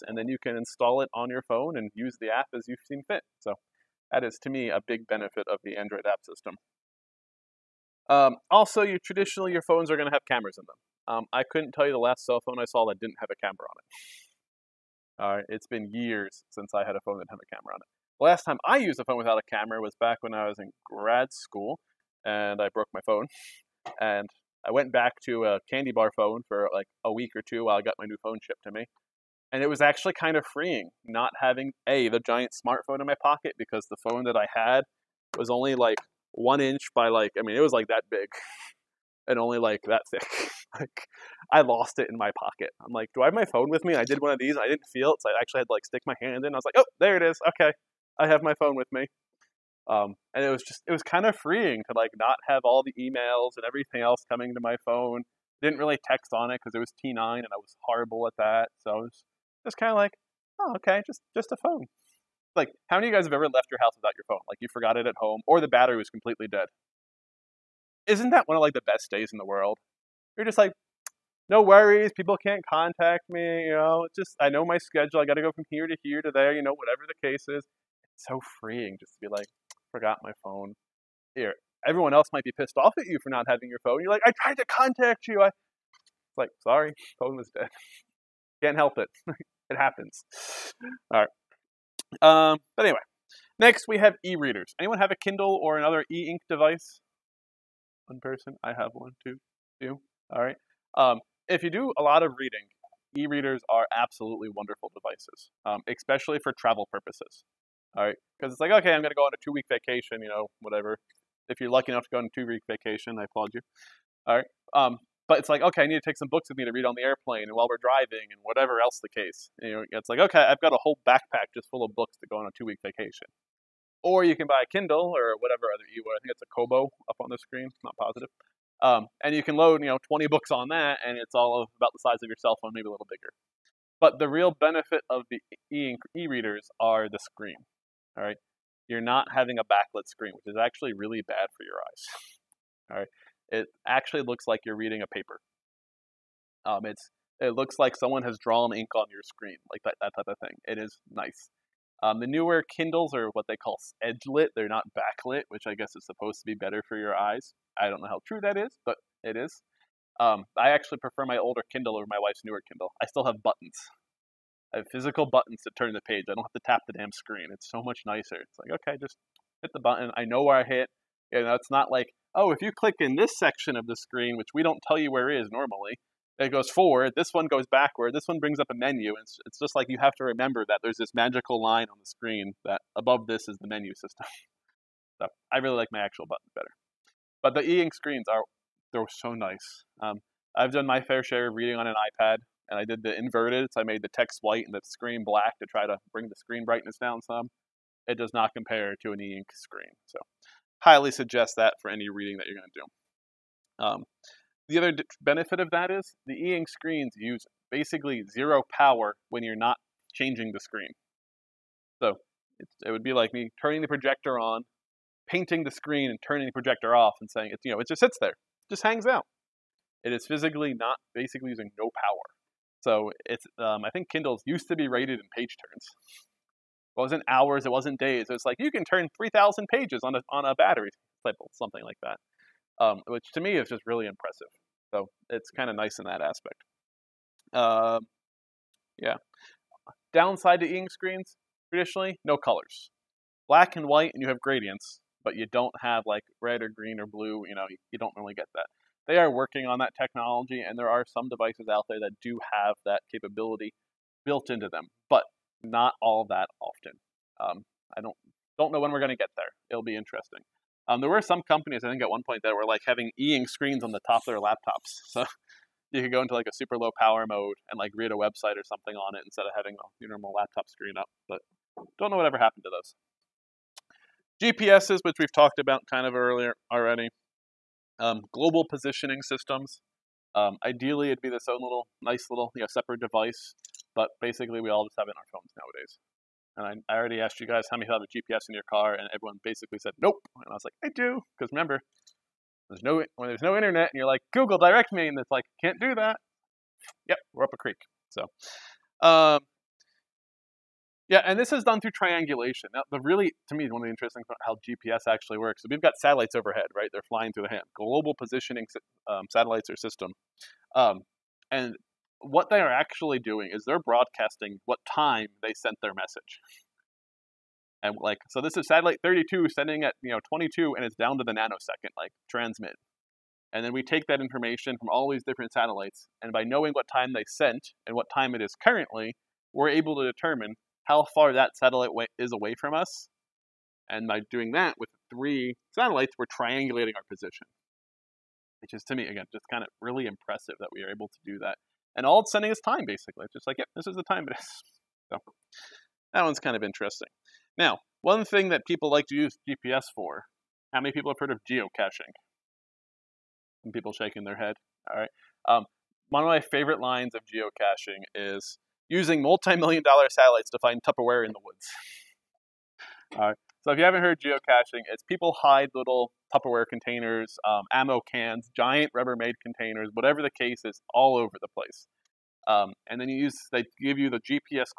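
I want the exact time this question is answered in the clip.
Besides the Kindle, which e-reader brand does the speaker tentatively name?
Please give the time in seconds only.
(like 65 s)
126 s.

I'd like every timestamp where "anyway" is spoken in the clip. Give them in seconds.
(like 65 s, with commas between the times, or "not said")
92 s.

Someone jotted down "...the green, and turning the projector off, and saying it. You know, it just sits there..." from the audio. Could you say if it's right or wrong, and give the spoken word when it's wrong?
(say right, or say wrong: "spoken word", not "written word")
wrong: "screen", not "green".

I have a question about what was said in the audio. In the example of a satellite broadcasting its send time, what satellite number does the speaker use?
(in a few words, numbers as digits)
32.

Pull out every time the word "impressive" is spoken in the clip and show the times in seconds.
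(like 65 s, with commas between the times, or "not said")
234 s, 340 s.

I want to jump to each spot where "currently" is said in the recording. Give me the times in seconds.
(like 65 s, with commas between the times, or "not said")
328 s.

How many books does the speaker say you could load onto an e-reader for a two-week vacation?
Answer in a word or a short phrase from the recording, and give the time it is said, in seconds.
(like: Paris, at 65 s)
20, at 130 s.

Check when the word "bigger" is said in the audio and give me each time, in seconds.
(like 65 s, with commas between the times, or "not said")
133 s.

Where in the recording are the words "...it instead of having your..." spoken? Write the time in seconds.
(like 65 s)
269 s.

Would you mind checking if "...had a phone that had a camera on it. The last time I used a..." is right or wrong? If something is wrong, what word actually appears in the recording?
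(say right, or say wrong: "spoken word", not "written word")
right.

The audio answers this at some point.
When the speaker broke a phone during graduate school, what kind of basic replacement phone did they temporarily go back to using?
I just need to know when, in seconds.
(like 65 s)
25 s.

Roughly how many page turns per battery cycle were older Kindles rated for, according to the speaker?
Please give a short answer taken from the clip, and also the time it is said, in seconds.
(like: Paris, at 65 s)
3,000, at 229 s.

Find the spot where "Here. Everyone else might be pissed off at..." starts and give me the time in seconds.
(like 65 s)
81 s.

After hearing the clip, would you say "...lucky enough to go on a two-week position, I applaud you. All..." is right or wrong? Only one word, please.
wrong.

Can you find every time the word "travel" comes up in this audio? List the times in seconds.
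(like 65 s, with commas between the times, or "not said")
106 s.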